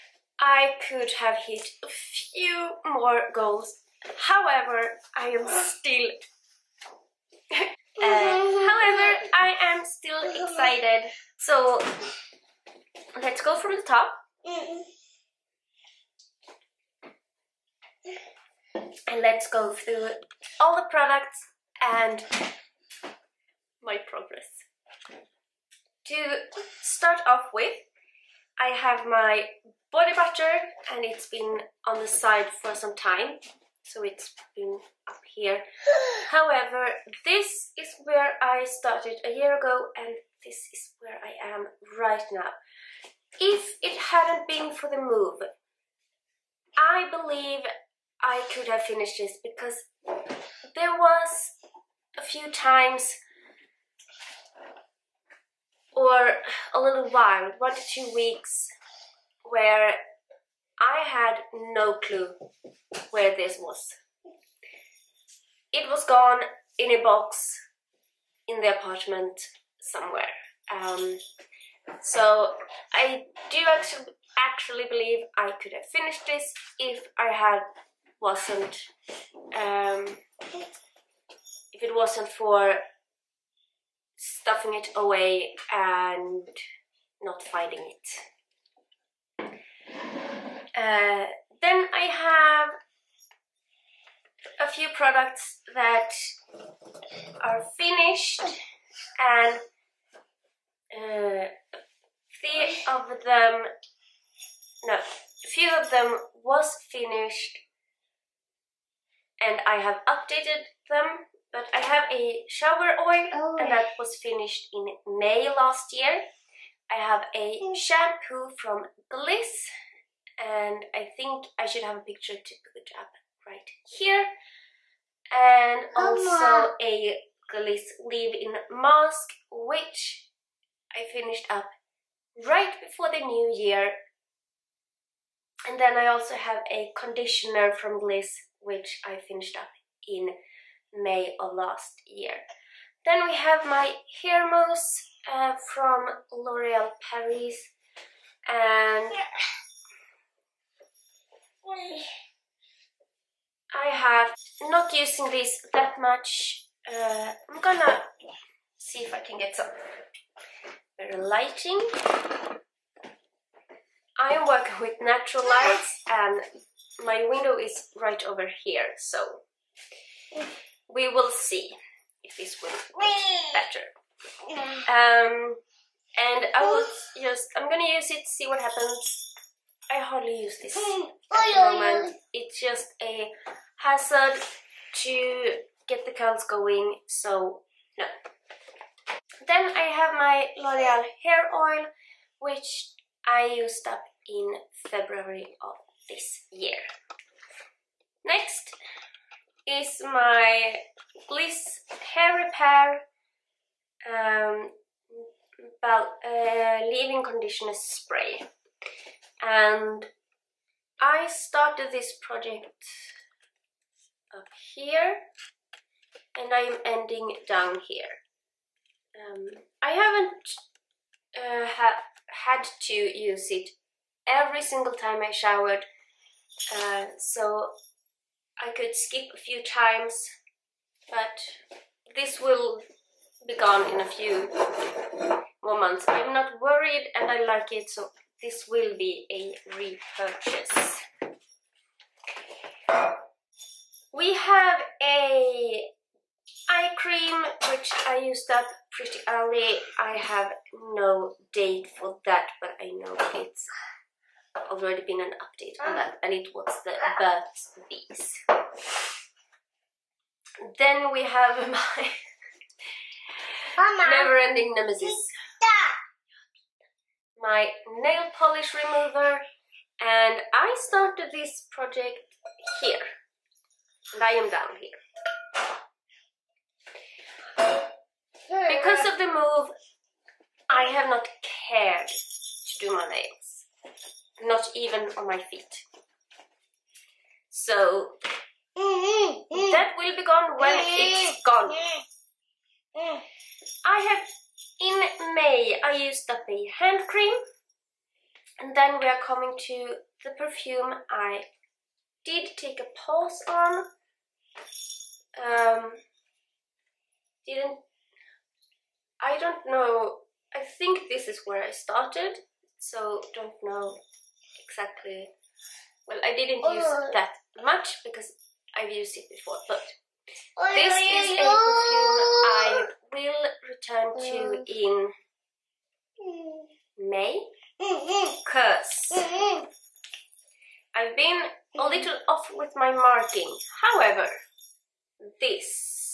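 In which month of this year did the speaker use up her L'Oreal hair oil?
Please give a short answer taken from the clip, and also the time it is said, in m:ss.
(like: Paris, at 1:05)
February, at 3:14.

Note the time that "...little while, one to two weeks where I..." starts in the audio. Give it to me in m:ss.
0:56.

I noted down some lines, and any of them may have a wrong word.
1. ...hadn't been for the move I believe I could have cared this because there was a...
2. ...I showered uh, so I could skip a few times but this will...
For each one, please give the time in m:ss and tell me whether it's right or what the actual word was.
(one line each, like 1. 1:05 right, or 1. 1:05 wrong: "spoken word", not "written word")
1. 0:44 wrong: "finished", not "cared"
2. 3:45 right.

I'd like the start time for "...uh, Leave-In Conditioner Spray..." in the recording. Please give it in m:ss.
3:25.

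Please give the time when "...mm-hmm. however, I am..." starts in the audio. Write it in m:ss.
0:07.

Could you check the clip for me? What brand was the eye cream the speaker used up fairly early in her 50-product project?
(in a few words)
Burt's Bees.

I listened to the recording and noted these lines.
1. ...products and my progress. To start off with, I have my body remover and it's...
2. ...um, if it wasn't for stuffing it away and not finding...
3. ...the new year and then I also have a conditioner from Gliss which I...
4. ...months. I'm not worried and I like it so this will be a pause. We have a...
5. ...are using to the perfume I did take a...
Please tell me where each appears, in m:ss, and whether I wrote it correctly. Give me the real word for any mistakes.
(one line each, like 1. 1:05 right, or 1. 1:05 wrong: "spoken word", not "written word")
1. 0:20 wrong: "butter", not "remover"
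2. 1:19 right
3. 2:13 right
4. 3:55 wrong: "repurchase", not "pause"
5. 4:59 wrong: "coming", not "using".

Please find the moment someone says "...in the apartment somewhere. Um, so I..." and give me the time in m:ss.
1:08.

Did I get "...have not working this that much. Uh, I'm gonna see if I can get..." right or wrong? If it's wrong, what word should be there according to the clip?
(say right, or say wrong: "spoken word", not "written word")
wrong: "using", not "working".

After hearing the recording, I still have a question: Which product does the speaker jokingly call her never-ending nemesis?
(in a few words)
Nail polish remover.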